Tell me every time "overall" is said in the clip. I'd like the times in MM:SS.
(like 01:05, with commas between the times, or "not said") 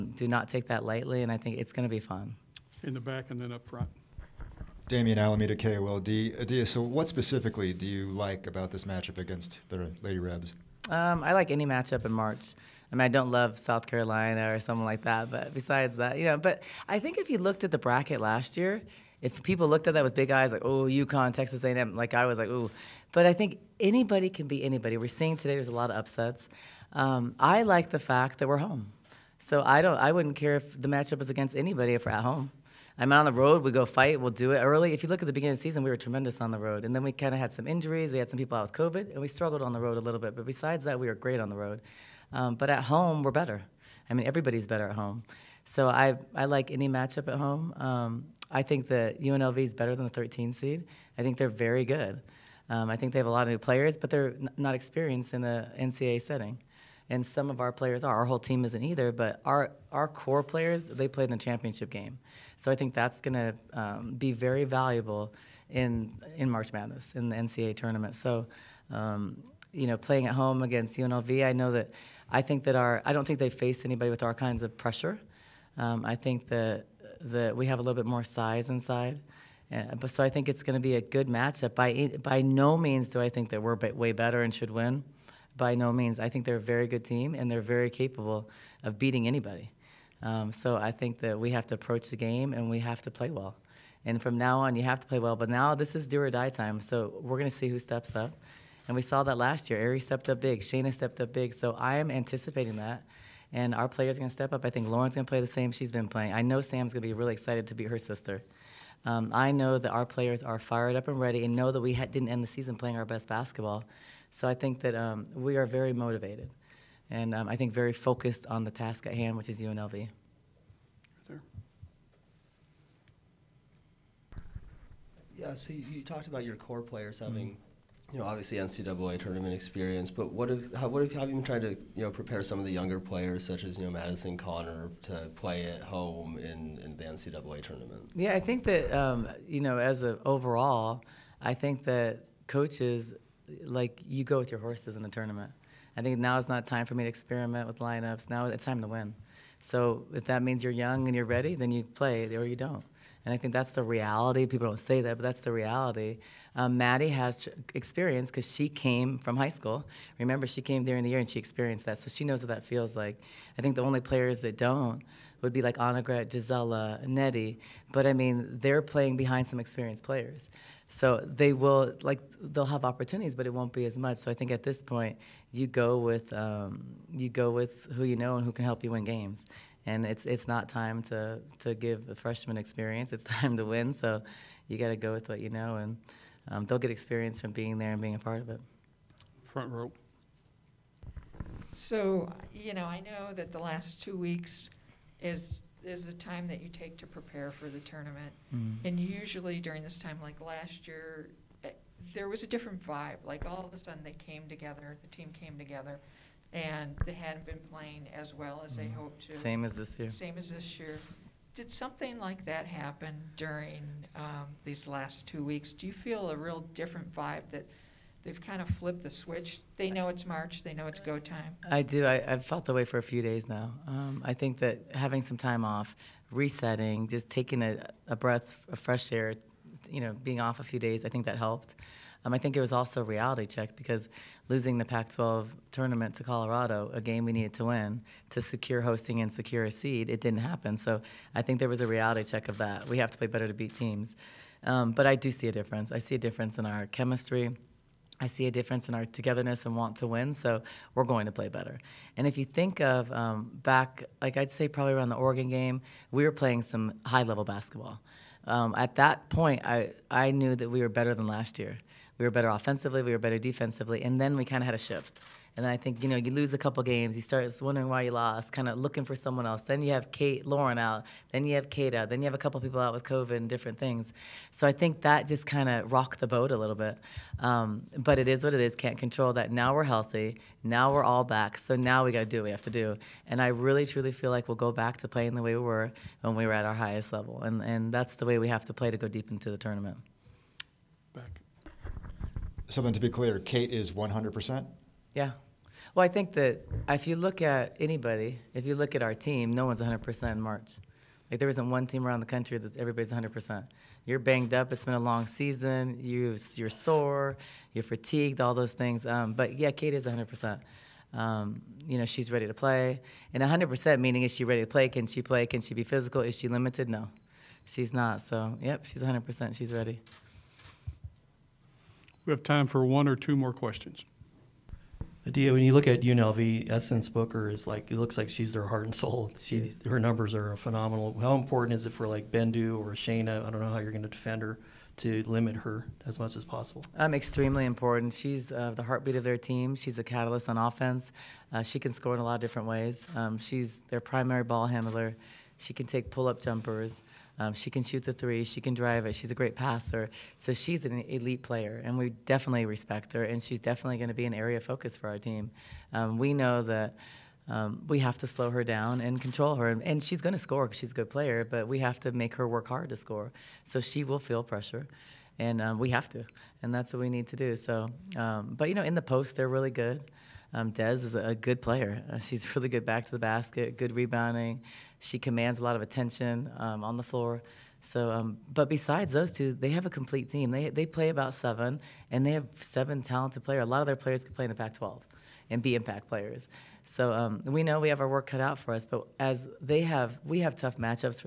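02:20.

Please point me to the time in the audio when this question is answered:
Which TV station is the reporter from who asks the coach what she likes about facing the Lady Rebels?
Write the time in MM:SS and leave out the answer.
00:05.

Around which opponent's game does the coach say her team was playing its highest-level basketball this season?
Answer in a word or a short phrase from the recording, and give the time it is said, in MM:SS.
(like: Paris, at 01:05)
Oregon, at 04:15.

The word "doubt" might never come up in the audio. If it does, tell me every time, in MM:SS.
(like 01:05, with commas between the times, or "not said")
not said.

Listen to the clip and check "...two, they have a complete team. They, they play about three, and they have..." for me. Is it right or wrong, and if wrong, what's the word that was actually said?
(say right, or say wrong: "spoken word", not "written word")
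wrong: "seven", not "three".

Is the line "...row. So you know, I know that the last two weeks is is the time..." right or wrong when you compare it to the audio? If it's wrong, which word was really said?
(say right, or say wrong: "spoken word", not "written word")
right.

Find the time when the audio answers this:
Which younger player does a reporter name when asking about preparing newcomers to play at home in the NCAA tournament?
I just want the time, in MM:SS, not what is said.
02:13.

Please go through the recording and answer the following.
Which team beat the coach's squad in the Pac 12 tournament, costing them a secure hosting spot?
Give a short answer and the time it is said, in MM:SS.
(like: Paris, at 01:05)
Colorado, at 03:56.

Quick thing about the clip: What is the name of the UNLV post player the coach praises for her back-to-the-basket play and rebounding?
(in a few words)
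Dez.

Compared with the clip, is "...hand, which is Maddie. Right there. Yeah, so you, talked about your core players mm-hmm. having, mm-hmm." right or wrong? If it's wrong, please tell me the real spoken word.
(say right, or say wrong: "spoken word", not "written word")
wrong: "UNLV", not "Maddie".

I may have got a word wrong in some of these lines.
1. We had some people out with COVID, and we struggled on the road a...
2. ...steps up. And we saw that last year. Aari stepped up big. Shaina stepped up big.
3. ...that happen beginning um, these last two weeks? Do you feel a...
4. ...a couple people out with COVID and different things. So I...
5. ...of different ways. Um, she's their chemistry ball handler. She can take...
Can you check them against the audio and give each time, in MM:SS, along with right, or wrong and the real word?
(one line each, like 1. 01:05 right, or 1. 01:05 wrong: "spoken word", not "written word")
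1. 00:38 right
2. 01:37 right
3. 03:32 wrong: "during", not "beginning"
4. 04:32 right
5. 05:42 wrong: "primary", not "chemistry".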